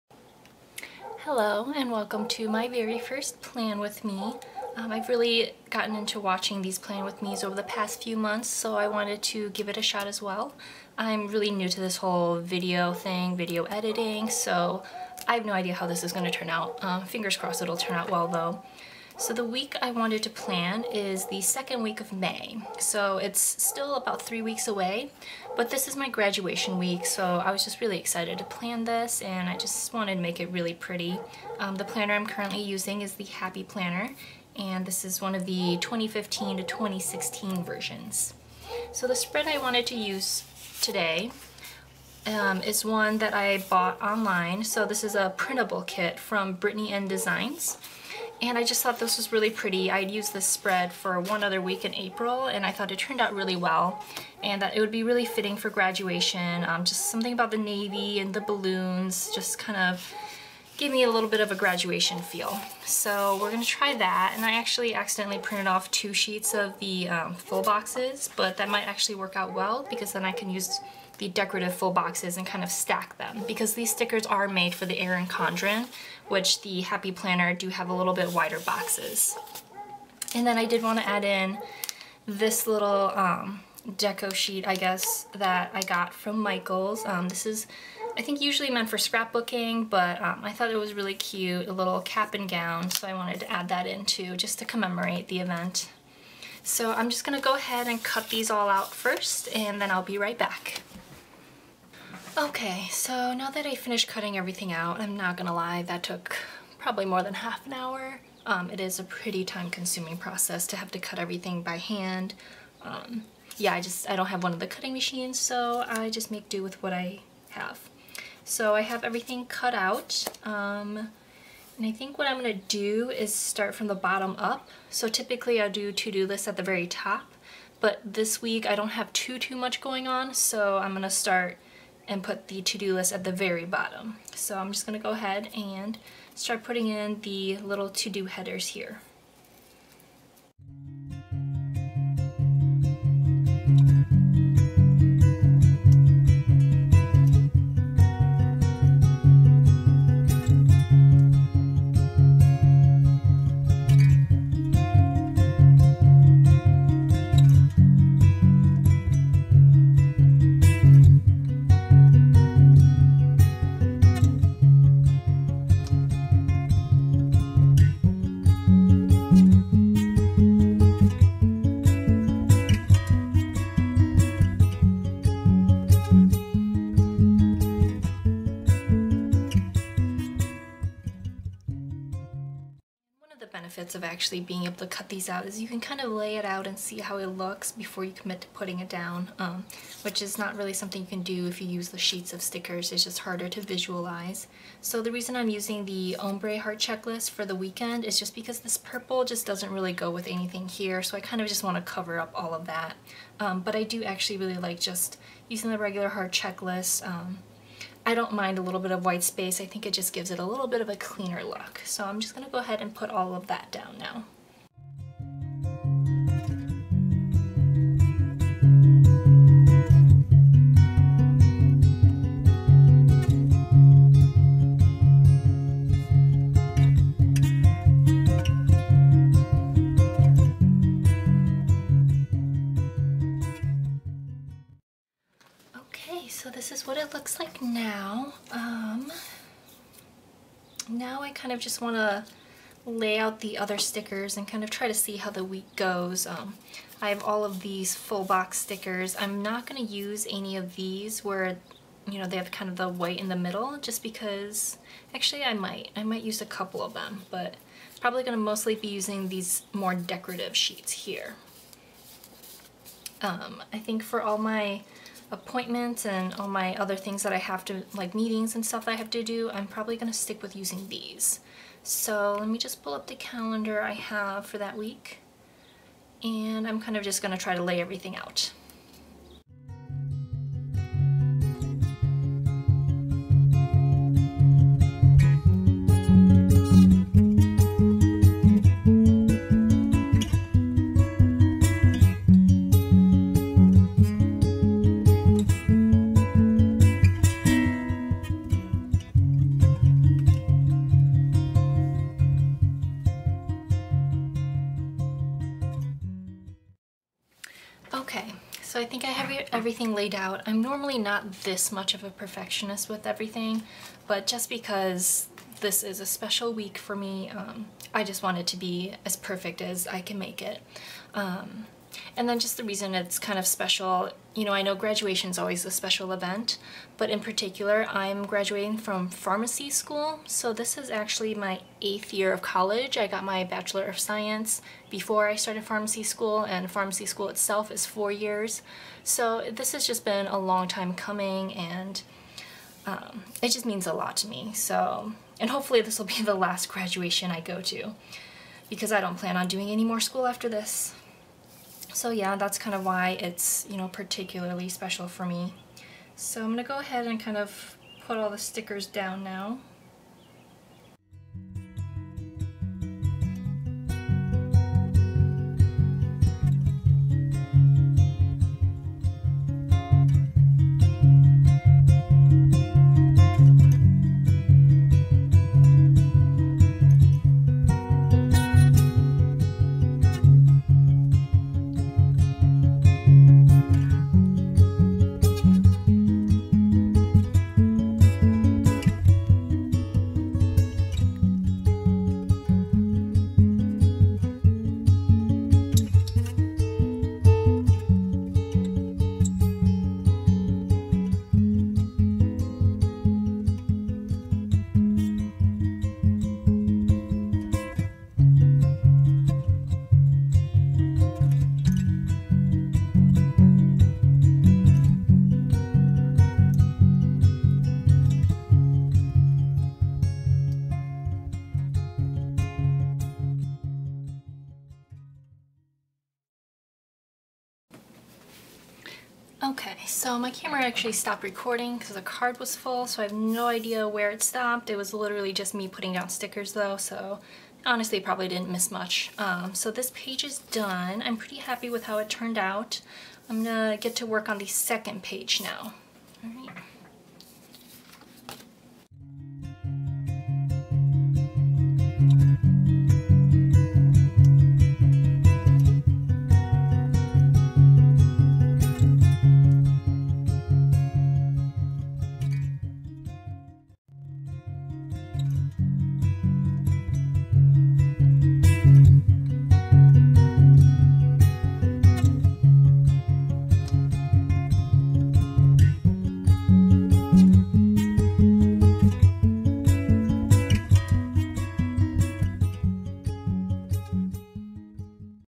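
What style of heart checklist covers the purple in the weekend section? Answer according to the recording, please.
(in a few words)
ombre heart checklist.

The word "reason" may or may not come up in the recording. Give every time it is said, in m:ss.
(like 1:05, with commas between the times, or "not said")
3:15, 5:22.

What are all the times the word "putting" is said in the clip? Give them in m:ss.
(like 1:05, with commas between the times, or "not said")
2:16, 3:08, 7:15.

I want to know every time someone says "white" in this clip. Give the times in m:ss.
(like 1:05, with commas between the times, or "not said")
3:29, 4:12.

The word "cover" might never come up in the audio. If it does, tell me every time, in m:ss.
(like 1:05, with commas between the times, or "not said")
3:21.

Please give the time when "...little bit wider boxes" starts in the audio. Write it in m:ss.
1:17.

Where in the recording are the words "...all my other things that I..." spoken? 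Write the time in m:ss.
4:26.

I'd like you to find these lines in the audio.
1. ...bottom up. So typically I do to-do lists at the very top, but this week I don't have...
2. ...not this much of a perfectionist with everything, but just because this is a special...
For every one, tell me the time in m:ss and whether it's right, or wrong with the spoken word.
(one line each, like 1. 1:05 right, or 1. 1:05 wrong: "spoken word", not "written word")
1. 2:03 right
2. 5:10 right.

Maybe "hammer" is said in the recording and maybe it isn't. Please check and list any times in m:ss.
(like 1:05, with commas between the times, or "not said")
not said.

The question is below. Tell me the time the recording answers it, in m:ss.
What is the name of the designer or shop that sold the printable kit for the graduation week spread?
0:46.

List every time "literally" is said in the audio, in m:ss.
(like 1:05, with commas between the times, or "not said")
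7:14.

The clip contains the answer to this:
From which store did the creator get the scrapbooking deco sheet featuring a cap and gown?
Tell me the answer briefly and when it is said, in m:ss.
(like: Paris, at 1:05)
Michaels, at 1:26.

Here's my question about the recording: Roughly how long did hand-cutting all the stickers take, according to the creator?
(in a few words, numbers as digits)
more than half an hour.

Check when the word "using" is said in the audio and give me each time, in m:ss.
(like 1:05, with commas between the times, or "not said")
0:32, 3:15, 3:25, 4:18, 4:30.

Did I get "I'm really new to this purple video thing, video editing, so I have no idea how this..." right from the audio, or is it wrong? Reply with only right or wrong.
wrong.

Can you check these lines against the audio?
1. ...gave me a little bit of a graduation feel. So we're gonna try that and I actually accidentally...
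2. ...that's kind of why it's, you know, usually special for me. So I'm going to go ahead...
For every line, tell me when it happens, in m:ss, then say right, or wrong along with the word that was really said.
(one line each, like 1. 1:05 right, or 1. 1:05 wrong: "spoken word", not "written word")
1. 1:00 right
2. 5:52 wrong: "particularly", not "usually".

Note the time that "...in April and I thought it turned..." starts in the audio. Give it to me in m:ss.
0:51.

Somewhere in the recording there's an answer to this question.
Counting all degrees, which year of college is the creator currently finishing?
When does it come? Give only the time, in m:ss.
5:31.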